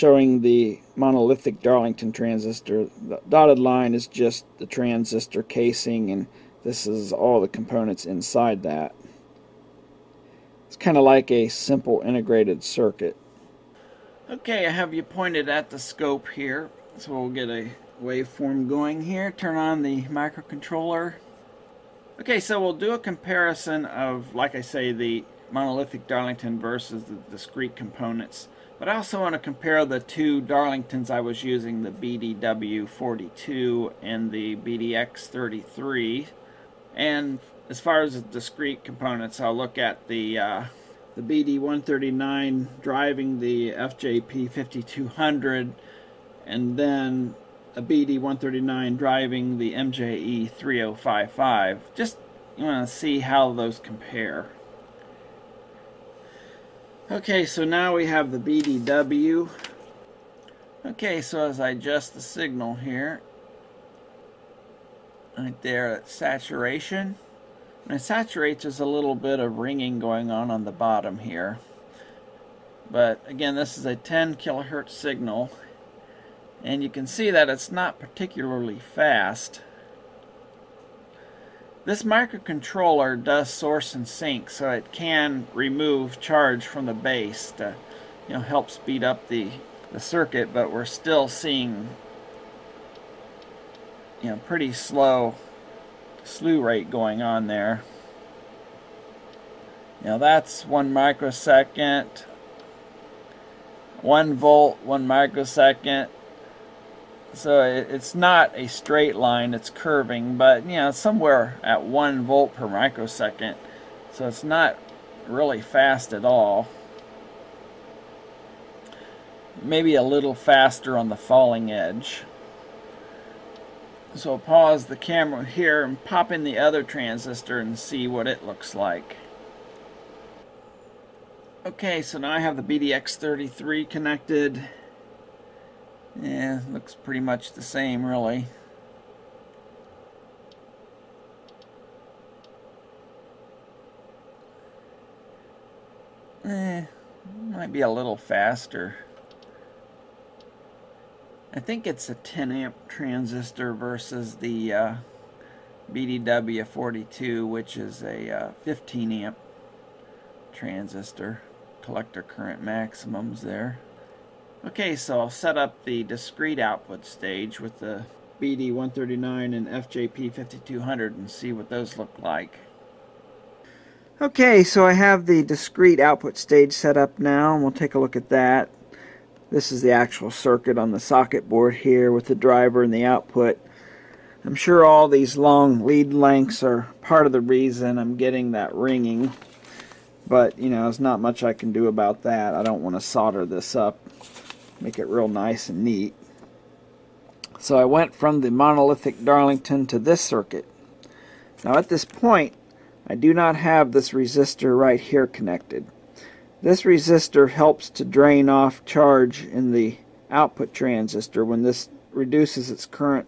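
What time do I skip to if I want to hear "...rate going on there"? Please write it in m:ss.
1:36.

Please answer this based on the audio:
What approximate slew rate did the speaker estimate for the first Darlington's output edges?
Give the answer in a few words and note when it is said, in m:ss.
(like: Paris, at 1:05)
1 volt per microsecond, at 1:51.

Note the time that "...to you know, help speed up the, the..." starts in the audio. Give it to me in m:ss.
1:27.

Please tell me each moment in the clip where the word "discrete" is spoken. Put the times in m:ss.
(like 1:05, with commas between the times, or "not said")
0:27, 0:38, 2:46, 2:55.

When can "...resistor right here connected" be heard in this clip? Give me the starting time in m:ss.
3:24.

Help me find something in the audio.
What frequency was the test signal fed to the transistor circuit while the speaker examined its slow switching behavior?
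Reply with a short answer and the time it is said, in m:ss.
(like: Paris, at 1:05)
10 kHz, at 1:13.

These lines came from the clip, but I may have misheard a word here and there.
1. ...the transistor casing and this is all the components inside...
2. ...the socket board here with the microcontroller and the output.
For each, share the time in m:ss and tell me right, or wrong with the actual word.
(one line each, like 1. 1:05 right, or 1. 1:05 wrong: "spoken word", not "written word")
1. 0:04 right
2. 3:00 wrong: "driver", not "microcontroller".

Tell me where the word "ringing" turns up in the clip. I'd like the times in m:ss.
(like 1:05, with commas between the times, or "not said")
1:09, 3:08.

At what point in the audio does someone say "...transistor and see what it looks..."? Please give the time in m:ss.
2:06.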